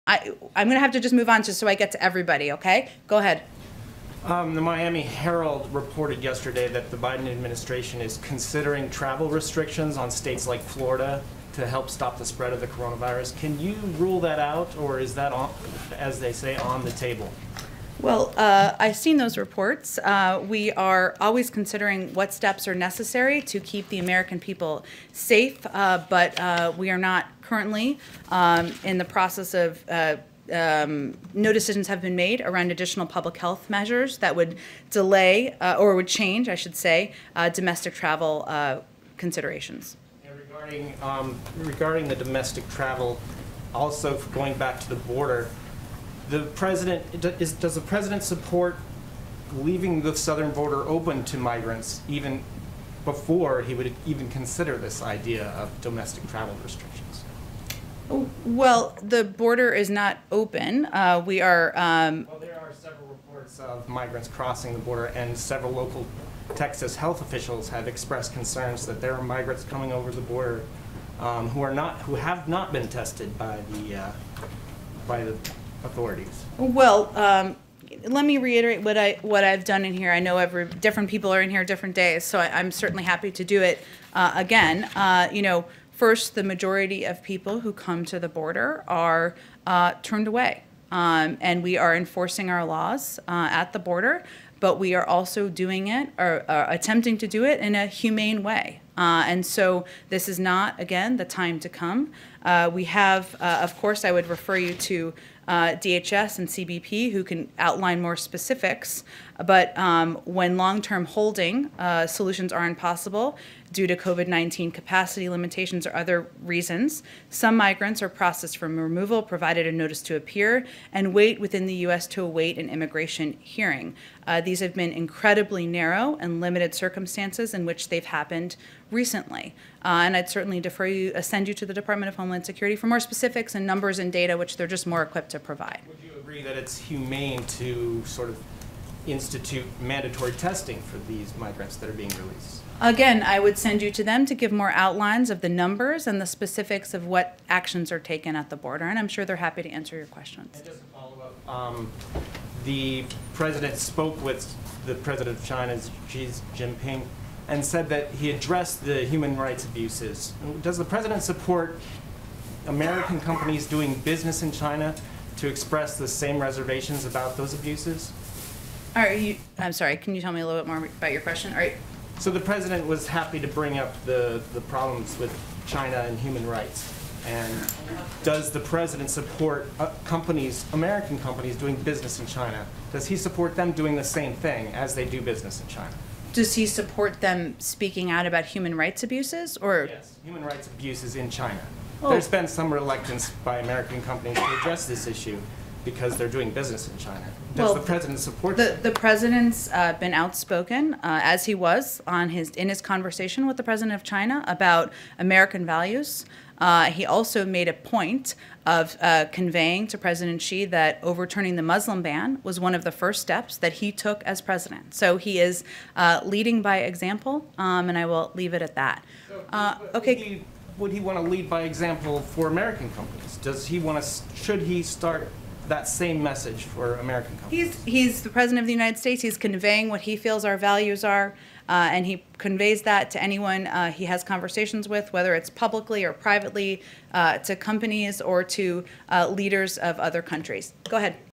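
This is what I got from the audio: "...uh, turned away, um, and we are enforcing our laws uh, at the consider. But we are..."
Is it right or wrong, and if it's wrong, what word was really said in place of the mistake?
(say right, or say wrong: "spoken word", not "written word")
wrong: "border", not "consider".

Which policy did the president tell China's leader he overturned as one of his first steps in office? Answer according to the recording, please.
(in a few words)
the Muslim ban.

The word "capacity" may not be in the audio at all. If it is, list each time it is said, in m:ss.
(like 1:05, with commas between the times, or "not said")
1:54.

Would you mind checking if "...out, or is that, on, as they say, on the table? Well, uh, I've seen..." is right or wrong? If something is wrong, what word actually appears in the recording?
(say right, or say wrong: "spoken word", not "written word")
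right.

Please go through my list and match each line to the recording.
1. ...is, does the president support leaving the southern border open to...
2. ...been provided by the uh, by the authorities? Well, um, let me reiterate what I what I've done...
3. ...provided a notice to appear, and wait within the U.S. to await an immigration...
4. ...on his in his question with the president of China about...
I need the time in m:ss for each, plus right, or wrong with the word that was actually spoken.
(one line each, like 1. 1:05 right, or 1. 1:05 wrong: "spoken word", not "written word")
1. 0:47 right
2. 1:12 wrong: "tested", not "provided"
3. 1:59 right
4. 3:22 wrong: "conversation", not "question".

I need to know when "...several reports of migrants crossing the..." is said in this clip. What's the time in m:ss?
1:02.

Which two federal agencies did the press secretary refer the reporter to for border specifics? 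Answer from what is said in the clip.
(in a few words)
DHS and CBP.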